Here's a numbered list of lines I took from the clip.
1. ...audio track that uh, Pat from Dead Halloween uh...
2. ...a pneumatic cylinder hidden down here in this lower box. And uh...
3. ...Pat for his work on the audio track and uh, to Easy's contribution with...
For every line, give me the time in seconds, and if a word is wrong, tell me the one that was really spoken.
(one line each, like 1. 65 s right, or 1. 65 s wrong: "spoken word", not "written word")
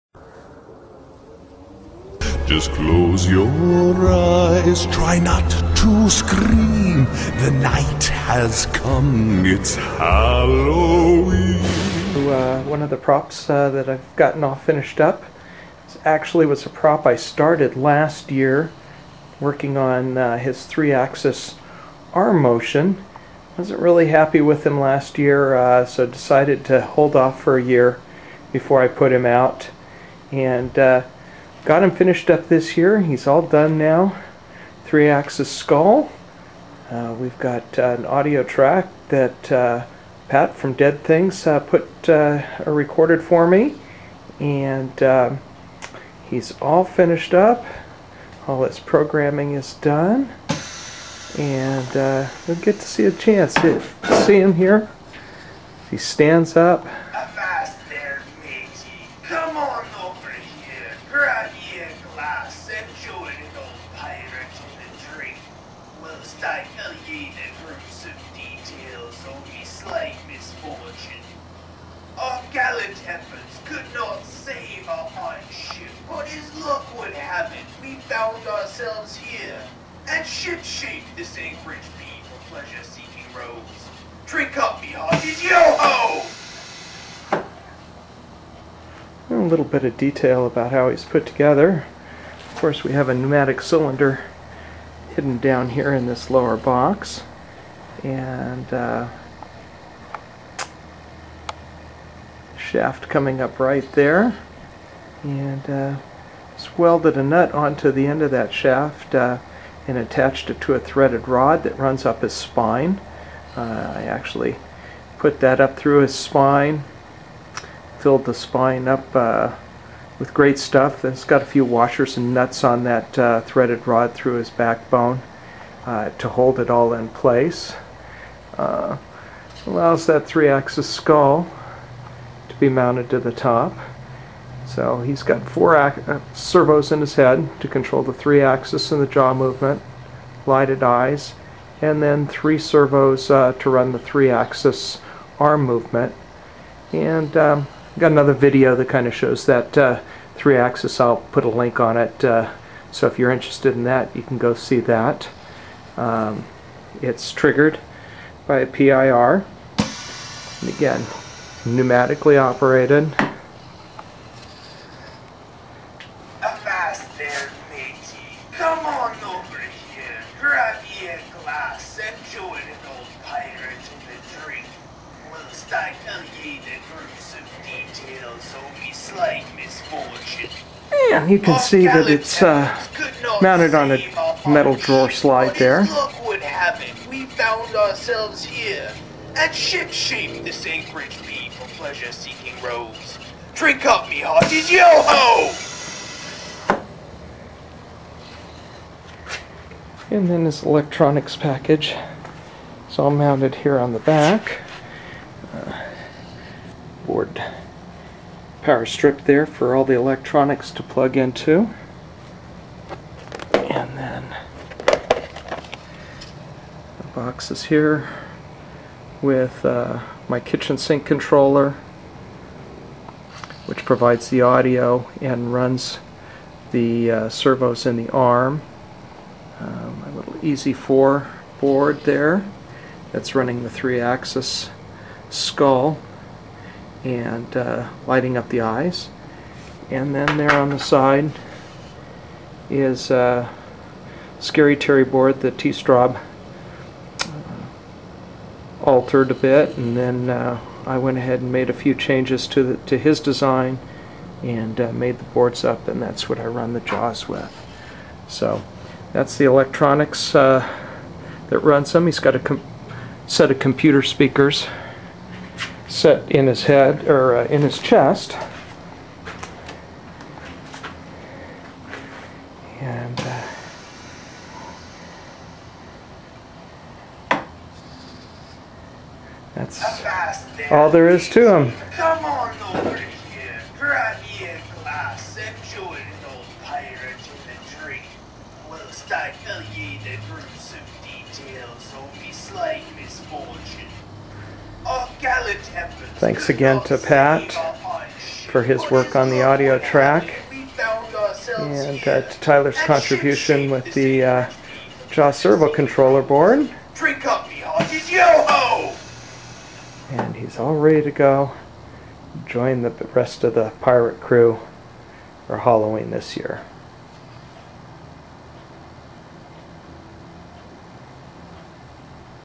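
1. 38 s wrong: "Things", not "Halloween"
2. 93 s right
3. 296 s wrong: "Tyler", not "Easy".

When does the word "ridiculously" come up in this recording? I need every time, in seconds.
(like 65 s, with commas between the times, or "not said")
not said.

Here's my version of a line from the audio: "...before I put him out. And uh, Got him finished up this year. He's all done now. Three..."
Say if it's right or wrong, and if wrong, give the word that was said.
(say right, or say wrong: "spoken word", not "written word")
right.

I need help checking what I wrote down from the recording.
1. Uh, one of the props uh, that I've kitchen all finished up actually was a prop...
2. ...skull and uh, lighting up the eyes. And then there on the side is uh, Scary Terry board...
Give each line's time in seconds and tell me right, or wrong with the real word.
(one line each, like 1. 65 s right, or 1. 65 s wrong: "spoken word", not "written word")
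1. 12 s wrong: "gotten", not "kitchen"
2. 235 s right.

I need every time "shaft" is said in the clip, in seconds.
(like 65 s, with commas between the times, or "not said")
102 s, 108 s.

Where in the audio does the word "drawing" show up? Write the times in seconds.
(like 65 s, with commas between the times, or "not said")
not said.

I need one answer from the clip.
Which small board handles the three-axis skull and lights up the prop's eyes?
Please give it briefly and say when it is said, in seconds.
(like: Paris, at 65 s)
Easy 4, at 230 s.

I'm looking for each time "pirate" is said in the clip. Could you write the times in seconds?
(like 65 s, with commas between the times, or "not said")
75 s, 286 s, 313 s.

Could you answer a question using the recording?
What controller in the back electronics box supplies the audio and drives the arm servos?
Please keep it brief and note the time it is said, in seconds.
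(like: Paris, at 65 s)
kitchen sink controller, at 220 s.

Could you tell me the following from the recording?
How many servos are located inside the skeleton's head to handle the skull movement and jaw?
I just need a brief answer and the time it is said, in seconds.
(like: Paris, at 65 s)
4, at 135 s.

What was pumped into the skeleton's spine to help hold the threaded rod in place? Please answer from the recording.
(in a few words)
Great Stuff.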